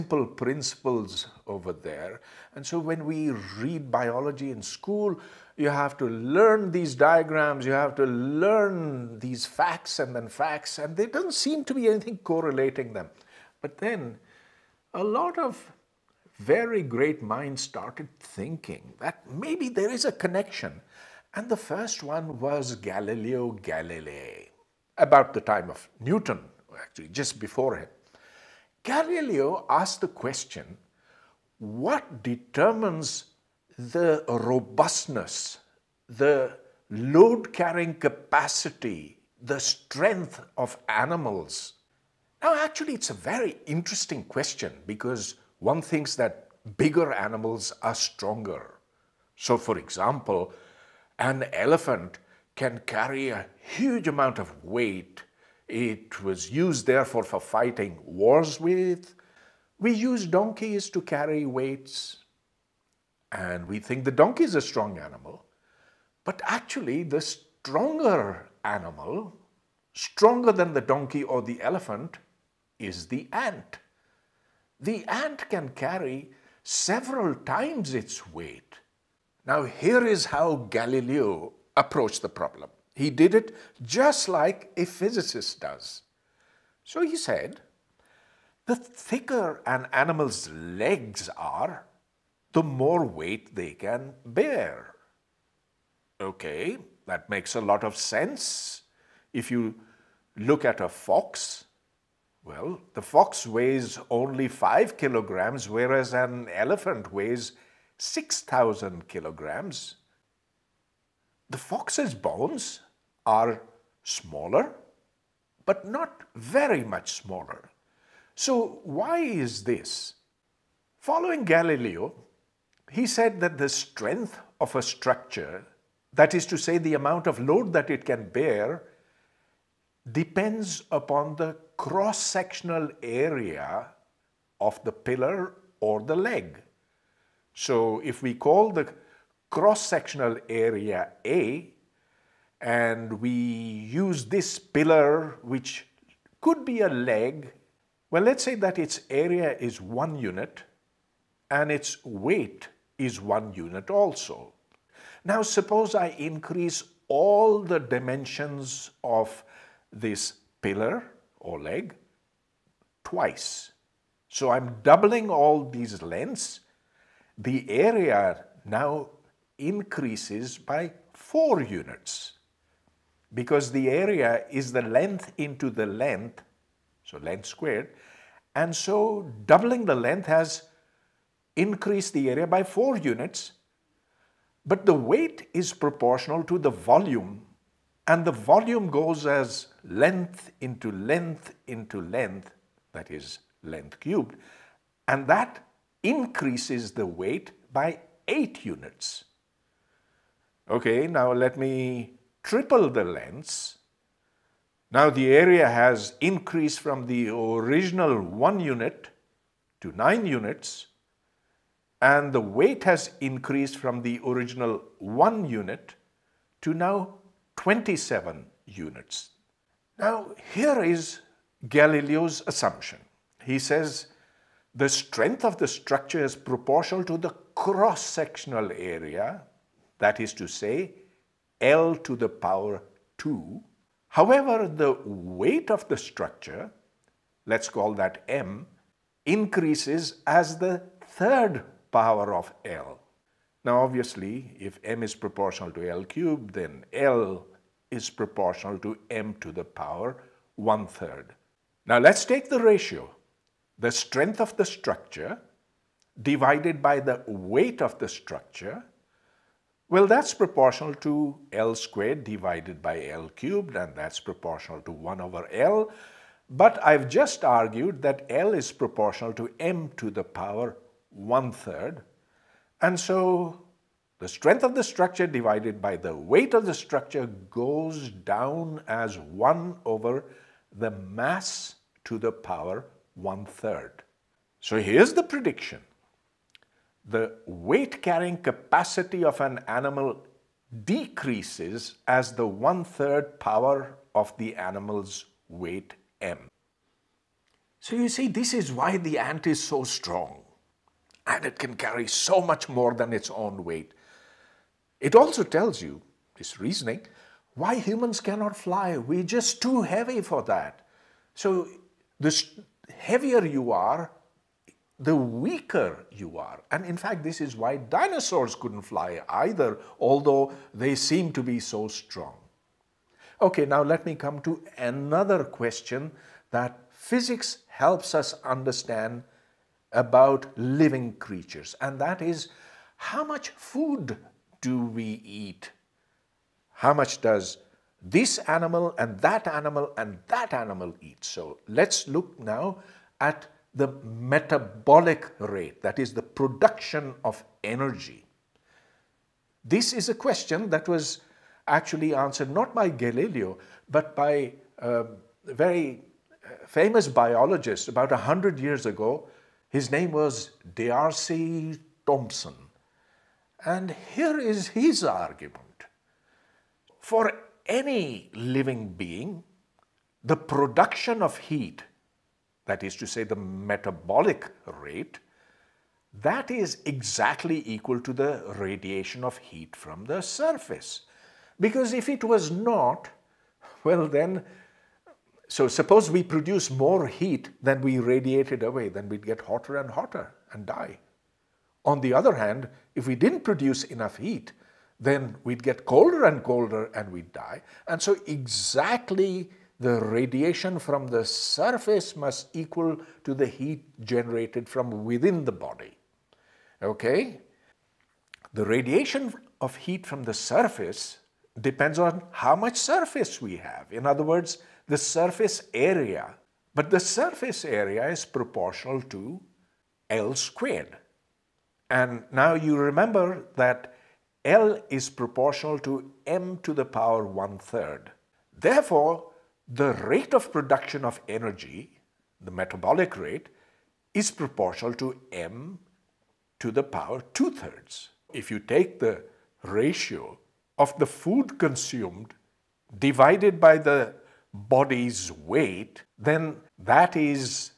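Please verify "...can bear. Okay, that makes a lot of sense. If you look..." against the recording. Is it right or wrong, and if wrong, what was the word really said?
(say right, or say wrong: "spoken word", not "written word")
right.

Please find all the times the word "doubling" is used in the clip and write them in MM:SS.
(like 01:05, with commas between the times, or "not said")
02:44, 02:59.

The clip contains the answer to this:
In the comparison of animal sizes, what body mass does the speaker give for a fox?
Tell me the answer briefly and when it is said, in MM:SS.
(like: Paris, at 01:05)
5 kilograms, at 01:44.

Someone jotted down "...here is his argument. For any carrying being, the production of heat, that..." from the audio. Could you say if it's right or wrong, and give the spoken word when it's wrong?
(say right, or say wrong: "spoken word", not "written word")
wrong: "living", not "carrying".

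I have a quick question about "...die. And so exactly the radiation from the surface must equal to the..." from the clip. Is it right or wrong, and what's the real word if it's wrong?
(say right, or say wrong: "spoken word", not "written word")
right.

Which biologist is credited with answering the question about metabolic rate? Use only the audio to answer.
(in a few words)
D'Arcy Thompson.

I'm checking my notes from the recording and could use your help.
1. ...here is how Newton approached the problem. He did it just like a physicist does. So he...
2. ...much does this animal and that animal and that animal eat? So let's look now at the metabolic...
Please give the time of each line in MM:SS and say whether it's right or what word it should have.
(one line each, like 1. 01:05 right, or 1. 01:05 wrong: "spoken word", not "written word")
1. 01:19 wrong: "Galileo", not "Newton"
2. 05:36 right.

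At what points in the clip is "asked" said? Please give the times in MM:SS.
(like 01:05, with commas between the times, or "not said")
00:29.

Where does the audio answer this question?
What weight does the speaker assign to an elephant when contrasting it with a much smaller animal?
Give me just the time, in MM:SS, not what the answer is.
01:47.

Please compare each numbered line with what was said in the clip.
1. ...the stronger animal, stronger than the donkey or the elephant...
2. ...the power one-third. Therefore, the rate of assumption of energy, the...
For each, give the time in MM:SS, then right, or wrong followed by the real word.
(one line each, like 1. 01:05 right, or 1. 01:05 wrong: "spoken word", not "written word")
1. 01:07 right
2. 07:06 wrong: "production", not "assumption".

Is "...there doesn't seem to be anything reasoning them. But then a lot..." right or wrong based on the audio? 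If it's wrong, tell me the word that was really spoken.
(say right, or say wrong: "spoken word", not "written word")
wrong: "correlating", not "reasoning".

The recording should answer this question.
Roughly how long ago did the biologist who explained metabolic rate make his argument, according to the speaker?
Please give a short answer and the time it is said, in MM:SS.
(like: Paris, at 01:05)
100 years ago, at 05:58.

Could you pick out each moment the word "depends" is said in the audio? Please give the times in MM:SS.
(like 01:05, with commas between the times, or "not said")
02:10, 06:51.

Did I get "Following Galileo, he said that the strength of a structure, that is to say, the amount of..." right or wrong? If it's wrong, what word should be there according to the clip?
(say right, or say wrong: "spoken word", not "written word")
right.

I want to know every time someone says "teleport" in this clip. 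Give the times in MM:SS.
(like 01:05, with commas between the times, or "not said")
not said.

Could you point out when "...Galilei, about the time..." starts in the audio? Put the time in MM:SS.
00:23.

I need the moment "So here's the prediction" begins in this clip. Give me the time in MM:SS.
04:44.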